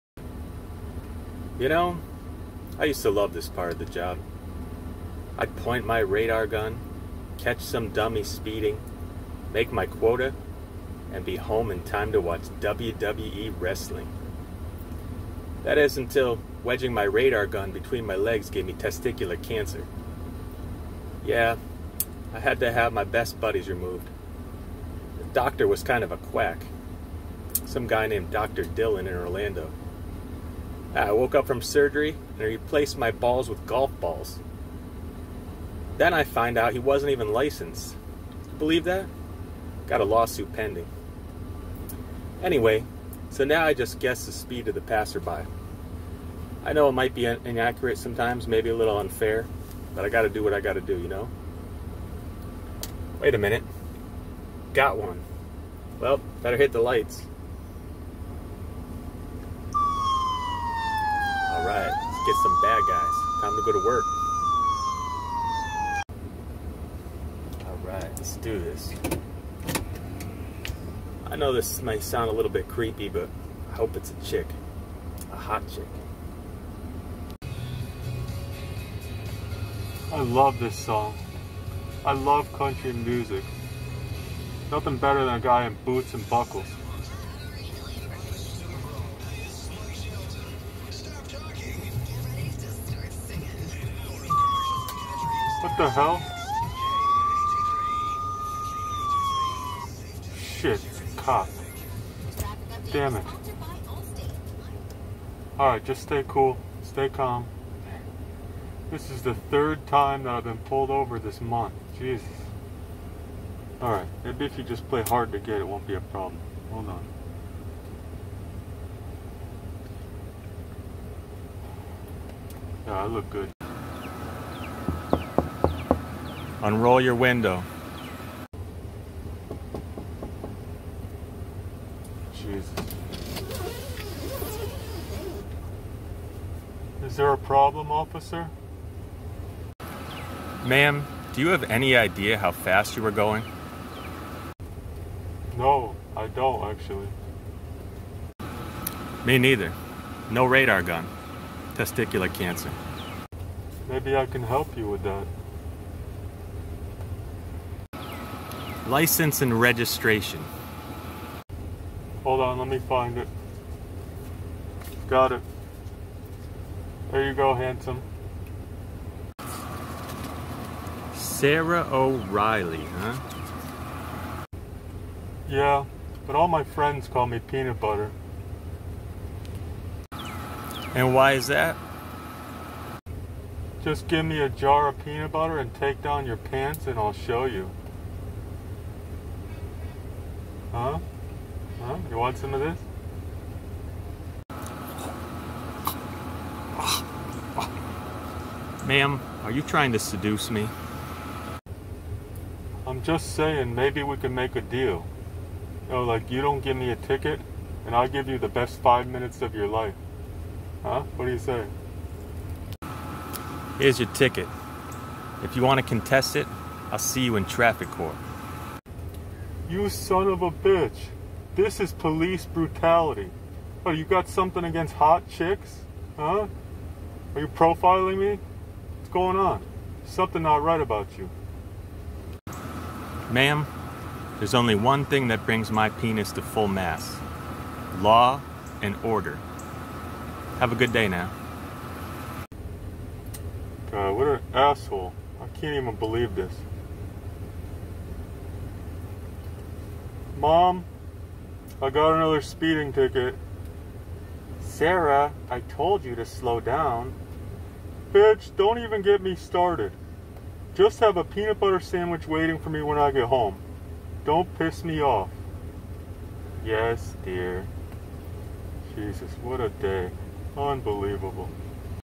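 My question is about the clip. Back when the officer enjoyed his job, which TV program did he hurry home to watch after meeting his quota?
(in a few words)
WWE wrestling.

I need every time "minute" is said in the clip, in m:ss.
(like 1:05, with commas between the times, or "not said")
0:53, 3:29.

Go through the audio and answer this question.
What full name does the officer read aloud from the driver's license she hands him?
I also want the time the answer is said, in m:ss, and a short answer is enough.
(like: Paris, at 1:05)
Sarah O'Reilly, at 2:51.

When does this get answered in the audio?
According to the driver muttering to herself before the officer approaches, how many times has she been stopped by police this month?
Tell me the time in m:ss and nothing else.
1:49.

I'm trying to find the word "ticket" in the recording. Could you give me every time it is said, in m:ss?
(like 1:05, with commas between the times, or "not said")
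3:26, 3:34, 4:12.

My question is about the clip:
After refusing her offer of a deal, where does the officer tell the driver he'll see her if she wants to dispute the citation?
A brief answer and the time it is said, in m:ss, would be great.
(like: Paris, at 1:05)
traffic court, at 3:37.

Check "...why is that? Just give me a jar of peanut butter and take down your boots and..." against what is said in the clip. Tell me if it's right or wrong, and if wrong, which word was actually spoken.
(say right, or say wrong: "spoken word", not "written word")
wrong: "pants", not "boots".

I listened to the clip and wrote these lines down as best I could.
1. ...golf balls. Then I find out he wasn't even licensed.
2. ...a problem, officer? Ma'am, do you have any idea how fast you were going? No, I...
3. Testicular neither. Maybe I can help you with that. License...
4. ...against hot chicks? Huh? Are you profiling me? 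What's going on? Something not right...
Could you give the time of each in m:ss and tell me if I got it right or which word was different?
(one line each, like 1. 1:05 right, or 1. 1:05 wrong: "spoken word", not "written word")
1. 0:33 right
2. 2:17 right
3. 2:31 wrong: "cancer", not "neither"
4. 3:44 right.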